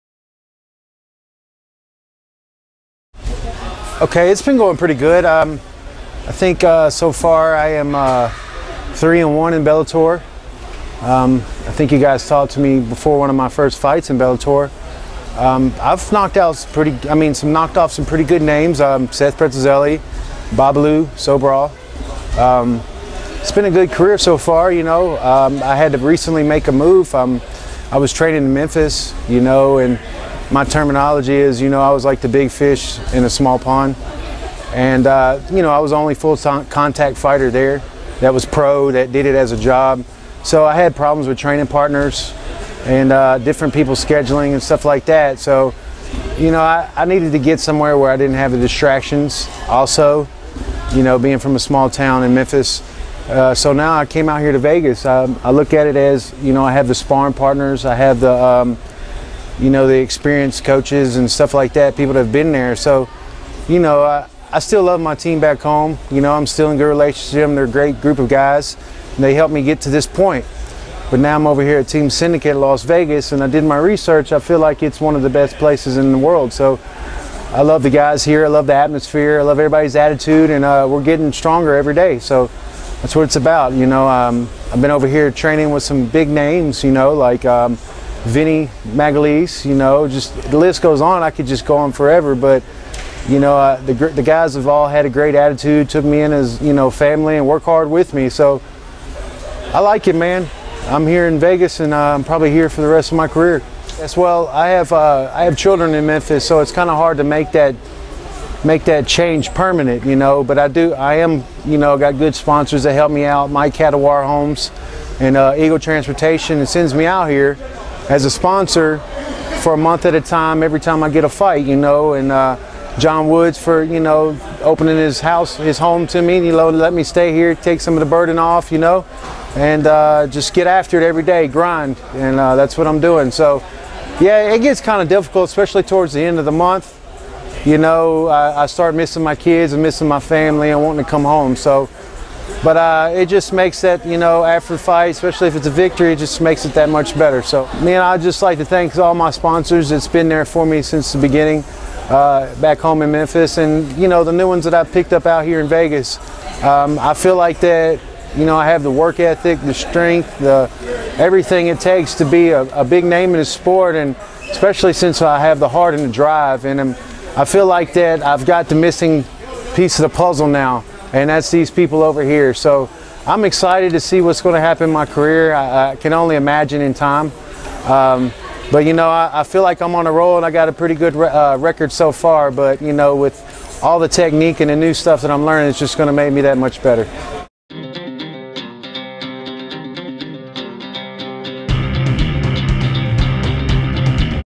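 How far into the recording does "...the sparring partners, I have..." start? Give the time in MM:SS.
00:56.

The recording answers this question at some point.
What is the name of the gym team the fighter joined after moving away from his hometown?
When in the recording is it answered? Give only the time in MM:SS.
01:11.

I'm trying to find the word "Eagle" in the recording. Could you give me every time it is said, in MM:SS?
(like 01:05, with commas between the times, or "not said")
01:55.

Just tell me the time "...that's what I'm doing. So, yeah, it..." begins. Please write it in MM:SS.
02:12.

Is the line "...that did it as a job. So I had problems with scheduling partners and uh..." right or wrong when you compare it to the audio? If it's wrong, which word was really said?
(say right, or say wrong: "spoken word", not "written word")
wrong: "training", not "scheduling".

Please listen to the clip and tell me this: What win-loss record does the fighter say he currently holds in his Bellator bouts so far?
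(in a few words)
3-1.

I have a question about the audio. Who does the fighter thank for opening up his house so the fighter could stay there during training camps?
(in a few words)
John Woods.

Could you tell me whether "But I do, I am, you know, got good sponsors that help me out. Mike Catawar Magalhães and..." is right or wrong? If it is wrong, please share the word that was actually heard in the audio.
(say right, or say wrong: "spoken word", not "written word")
wrong: "Homes", not "Magalhães".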